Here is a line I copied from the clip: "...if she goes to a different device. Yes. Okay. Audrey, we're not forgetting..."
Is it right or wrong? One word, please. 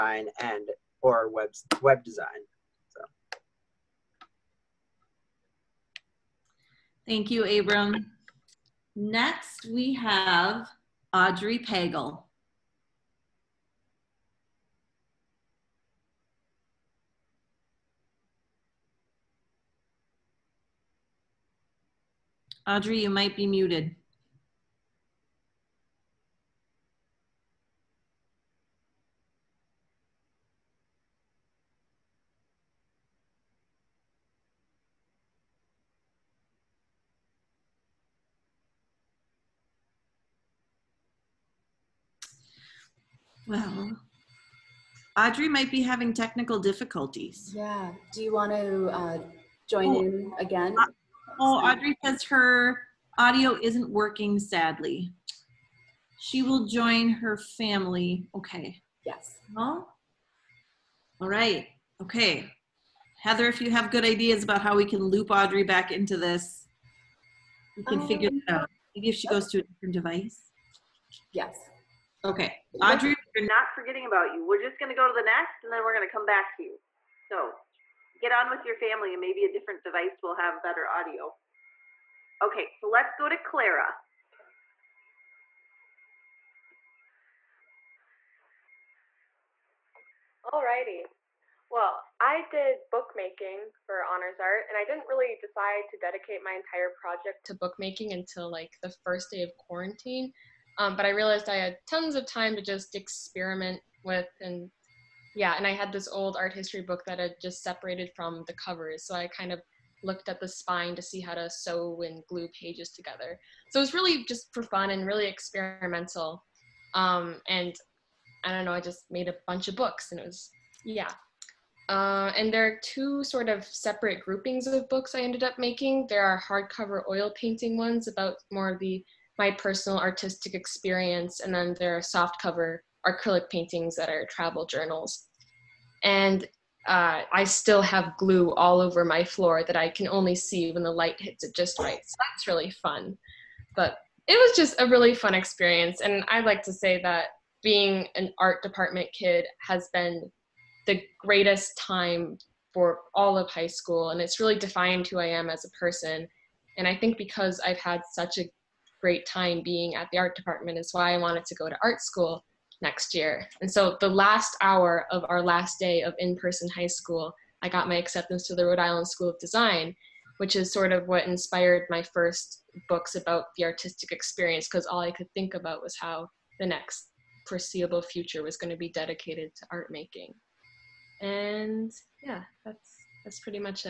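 right.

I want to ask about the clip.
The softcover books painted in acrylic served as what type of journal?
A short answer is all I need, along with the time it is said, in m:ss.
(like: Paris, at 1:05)
Travel journals, at 2:14.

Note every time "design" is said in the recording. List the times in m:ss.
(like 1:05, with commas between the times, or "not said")
0:02, 2:49.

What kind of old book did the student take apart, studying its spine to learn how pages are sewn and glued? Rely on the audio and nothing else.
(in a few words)
Art history book.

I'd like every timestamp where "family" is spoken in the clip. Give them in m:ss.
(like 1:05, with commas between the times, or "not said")
0:57, 1:18.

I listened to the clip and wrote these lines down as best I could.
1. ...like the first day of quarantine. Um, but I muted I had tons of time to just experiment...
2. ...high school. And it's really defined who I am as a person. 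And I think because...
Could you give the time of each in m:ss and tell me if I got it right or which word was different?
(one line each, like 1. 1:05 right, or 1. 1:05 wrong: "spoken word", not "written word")
1. 1:38 wrong: "realized", not "muted"
2. 2:33 right.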